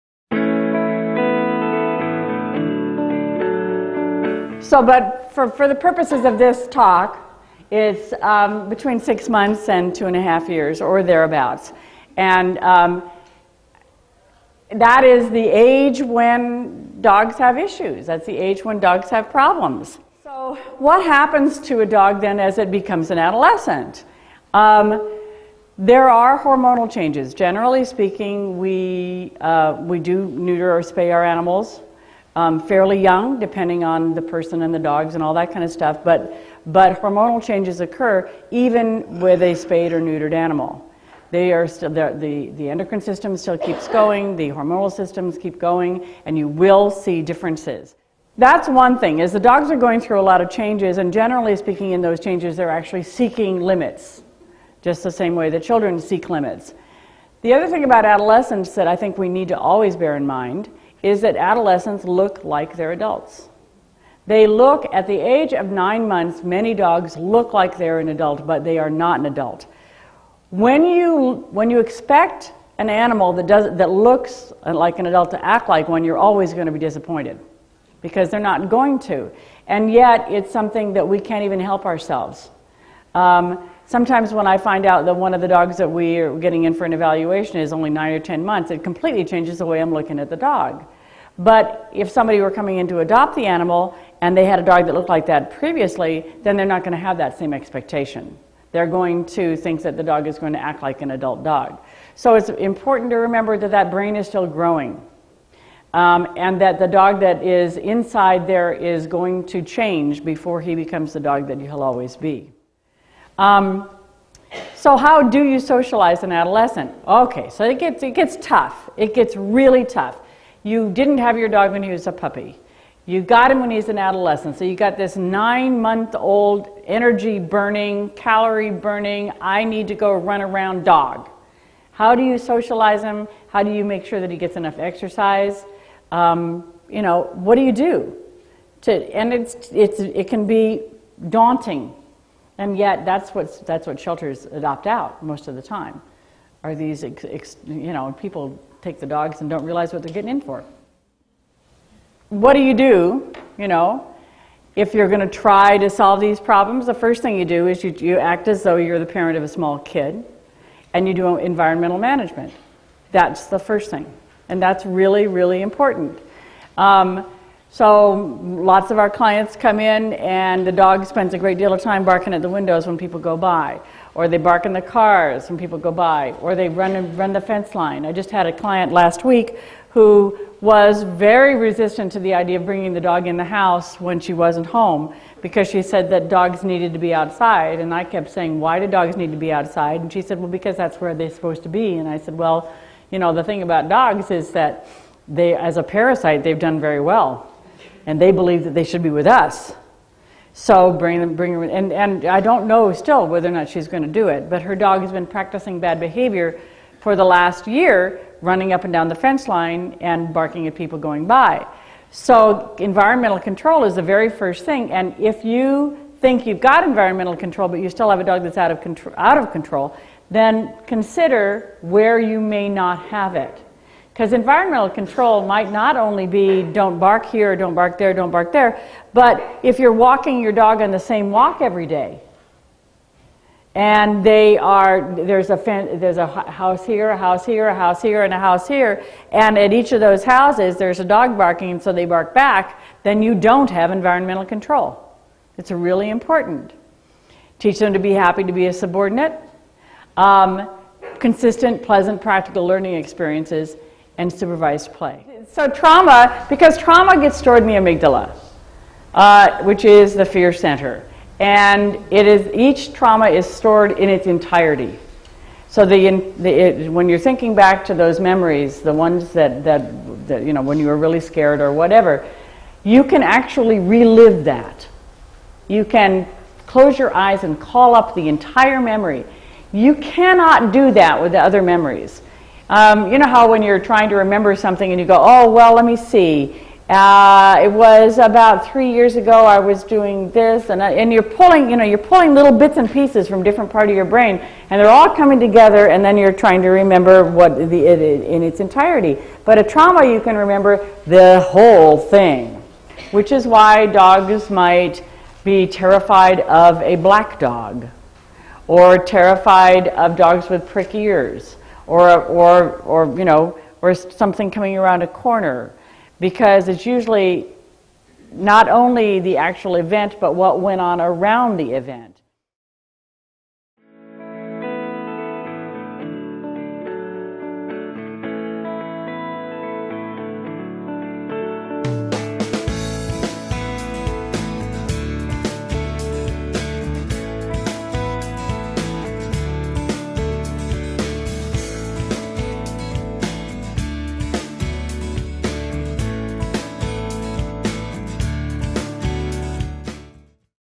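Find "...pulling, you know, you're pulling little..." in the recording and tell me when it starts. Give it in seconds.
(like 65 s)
291 s.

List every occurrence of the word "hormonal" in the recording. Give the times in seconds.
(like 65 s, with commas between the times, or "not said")
26 s, 37 s, 44 s.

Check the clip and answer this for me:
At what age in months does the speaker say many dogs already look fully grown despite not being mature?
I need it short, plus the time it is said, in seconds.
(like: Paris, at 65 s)
9 months, at 65 s.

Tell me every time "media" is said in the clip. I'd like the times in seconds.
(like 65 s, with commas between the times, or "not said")
not said.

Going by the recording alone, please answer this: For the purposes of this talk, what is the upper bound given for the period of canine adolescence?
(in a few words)
2.5 years.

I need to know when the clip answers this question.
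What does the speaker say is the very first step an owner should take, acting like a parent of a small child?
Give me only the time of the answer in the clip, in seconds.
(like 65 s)
161 s.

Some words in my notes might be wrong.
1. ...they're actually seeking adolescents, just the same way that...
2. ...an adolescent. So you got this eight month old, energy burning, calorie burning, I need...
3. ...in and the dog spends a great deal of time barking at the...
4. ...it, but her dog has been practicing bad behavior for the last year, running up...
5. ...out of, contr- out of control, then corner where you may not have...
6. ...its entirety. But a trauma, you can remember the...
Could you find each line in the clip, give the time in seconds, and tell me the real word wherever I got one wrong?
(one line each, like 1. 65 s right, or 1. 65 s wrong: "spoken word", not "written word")
1. 52 s wrong: "limits", not "adolescents"
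2. 123 s wrong: "nine", not "eight"
3. 169 s right
4. 204 s right
5. 218 s wrong: "consider", not "corner"
6. 298 s right.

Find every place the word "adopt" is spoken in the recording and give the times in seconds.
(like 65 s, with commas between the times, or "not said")
92 s, 144 s.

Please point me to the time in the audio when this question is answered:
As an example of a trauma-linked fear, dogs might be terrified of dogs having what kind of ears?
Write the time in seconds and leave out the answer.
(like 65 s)
310 s.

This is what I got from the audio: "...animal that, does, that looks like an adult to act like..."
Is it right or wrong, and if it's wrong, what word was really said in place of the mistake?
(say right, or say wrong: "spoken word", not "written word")
right.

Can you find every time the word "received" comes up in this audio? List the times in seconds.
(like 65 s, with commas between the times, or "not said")
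not said.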